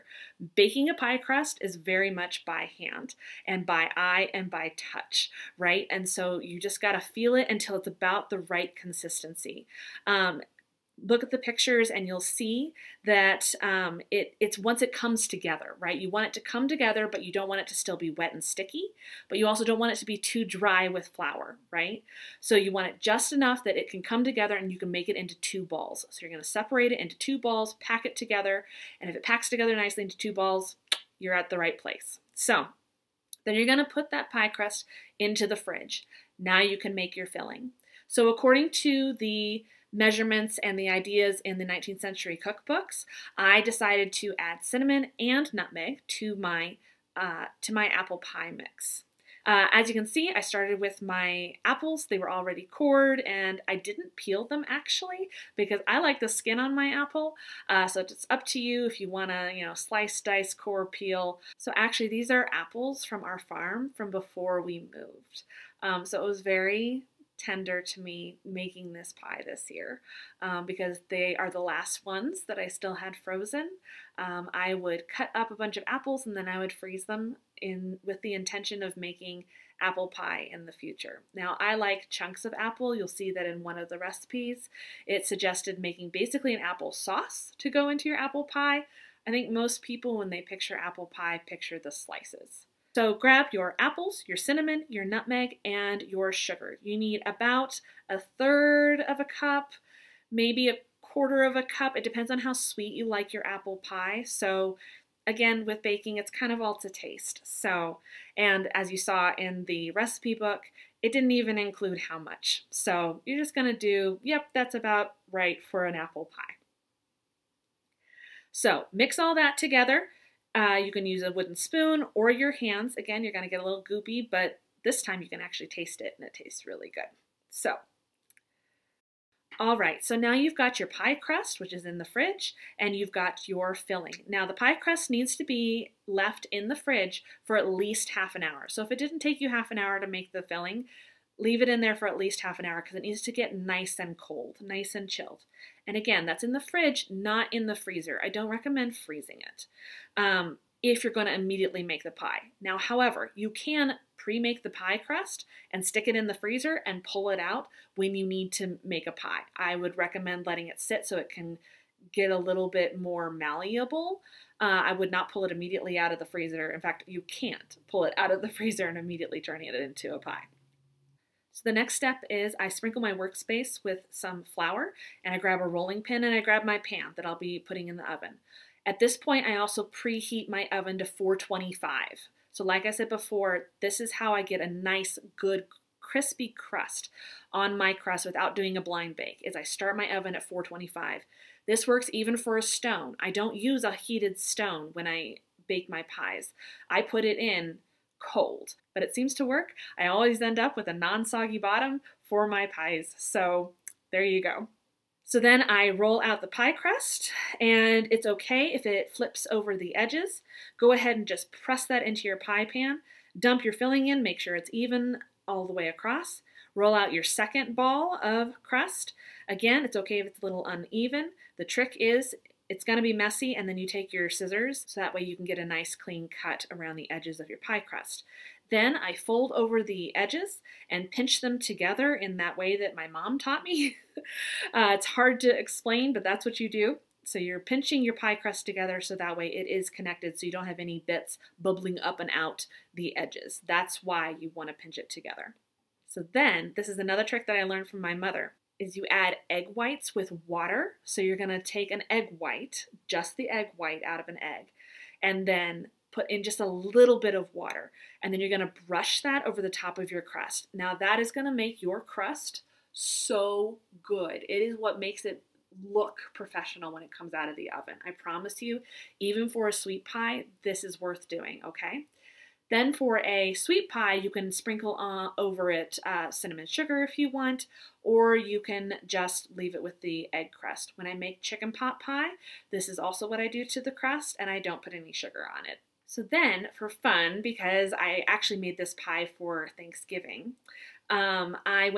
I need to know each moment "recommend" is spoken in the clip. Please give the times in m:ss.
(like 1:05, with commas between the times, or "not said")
2:28, 2:39.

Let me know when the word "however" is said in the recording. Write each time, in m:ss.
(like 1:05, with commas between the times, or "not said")
2:32.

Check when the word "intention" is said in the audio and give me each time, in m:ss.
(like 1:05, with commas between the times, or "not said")
1:18.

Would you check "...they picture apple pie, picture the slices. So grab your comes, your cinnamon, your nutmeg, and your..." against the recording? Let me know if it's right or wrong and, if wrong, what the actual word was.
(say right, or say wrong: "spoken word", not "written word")
wrong: "apples", not "comes".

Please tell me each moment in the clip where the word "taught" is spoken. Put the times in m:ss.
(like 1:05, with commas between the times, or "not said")
3:53.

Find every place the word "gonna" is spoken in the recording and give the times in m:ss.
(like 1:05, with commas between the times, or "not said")
0:26, 0:33, 1:53.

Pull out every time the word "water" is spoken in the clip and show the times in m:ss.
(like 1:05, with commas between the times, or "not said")
4:10, 4:17.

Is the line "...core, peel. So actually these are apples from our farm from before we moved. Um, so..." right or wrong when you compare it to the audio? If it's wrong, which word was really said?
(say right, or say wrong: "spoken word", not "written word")
right.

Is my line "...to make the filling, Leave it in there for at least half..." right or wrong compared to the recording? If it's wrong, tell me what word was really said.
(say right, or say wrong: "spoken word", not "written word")
right.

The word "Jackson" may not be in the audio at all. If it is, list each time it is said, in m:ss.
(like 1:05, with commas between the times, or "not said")
not said.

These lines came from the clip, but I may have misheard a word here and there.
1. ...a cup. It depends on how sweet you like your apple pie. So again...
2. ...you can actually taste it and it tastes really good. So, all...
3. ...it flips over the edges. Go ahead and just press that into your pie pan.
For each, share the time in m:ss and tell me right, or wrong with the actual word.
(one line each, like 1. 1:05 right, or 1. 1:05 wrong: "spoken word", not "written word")
1. 1:41 right
2. 2:05 right
3. 3:28 right.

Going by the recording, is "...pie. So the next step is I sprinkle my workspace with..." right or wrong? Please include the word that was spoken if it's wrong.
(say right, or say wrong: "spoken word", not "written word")
right.